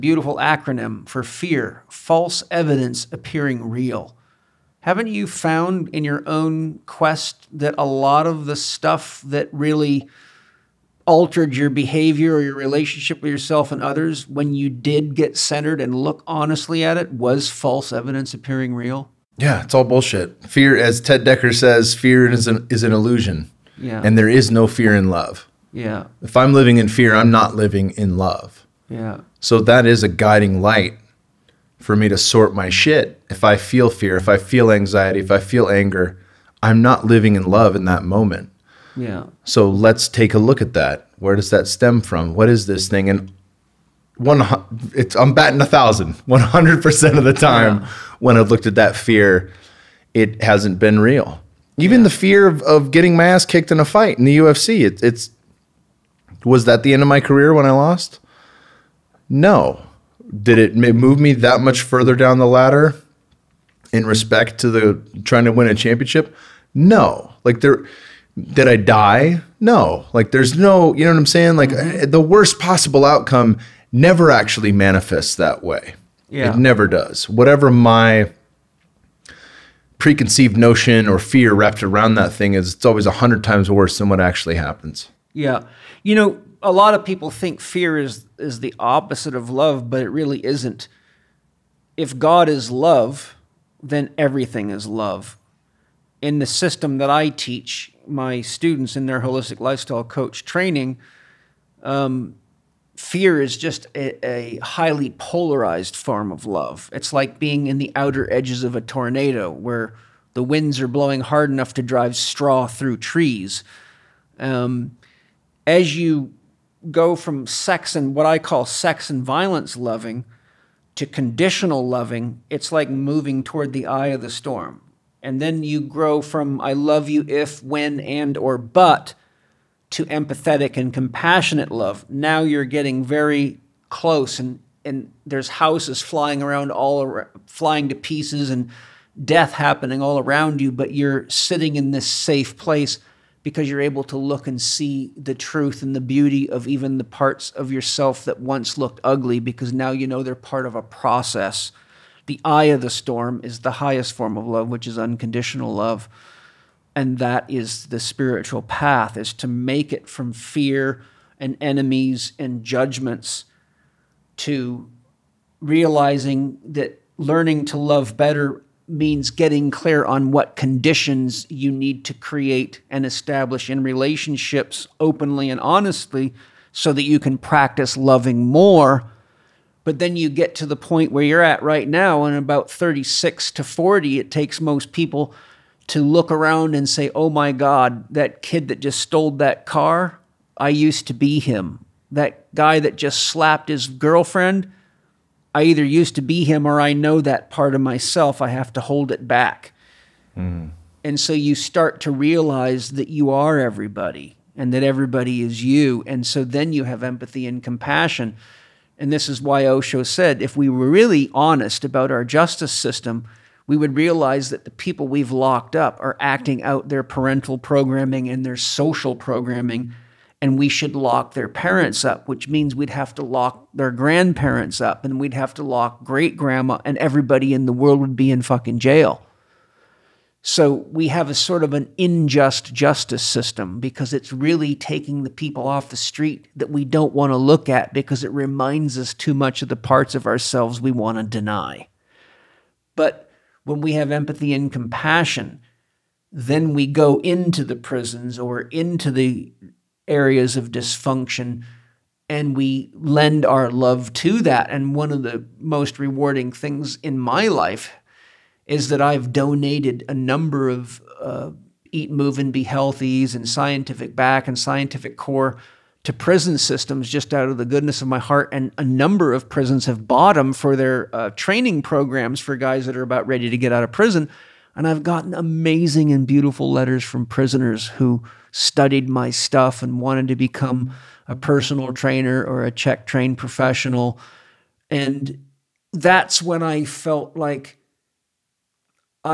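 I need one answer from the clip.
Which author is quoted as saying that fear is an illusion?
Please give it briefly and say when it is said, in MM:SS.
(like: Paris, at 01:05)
Ted Dekker, at 00:20.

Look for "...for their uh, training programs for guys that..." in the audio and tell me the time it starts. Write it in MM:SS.
04:30.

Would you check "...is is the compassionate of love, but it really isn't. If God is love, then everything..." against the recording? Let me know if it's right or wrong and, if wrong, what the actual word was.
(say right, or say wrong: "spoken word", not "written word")
wrong: "opposite", not "compassionate".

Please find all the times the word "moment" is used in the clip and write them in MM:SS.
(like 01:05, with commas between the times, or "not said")
00:38.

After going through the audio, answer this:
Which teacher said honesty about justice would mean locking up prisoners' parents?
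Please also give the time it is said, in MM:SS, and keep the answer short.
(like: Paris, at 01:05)
Osho, at 03:29.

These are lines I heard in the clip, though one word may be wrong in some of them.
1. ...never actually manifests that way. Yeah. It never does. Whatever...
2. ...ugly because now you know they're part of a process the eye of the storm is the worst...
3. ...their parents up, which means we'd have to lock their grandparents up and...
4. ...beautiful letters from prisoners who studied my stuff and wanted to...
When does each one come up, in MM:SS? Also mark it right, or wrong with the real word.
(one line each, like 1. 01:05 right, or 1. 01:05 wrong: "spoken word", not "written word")
1. 01:13 right
2. 02:29 wrong: "highest", not "worst"
3. 03:41 right
4. 04:36 right.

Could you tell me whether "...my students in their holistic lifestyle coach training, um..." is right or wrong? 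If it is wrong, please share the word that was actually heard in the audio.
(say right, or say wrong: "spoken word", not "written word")
right.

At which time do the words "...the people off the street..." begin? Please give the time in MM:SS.
03:55.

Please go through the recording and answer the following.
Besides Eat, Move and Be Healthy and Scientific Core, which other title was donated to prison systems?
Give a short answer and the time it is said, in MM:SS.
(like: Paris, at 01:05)
Scientific Back, at 04:23.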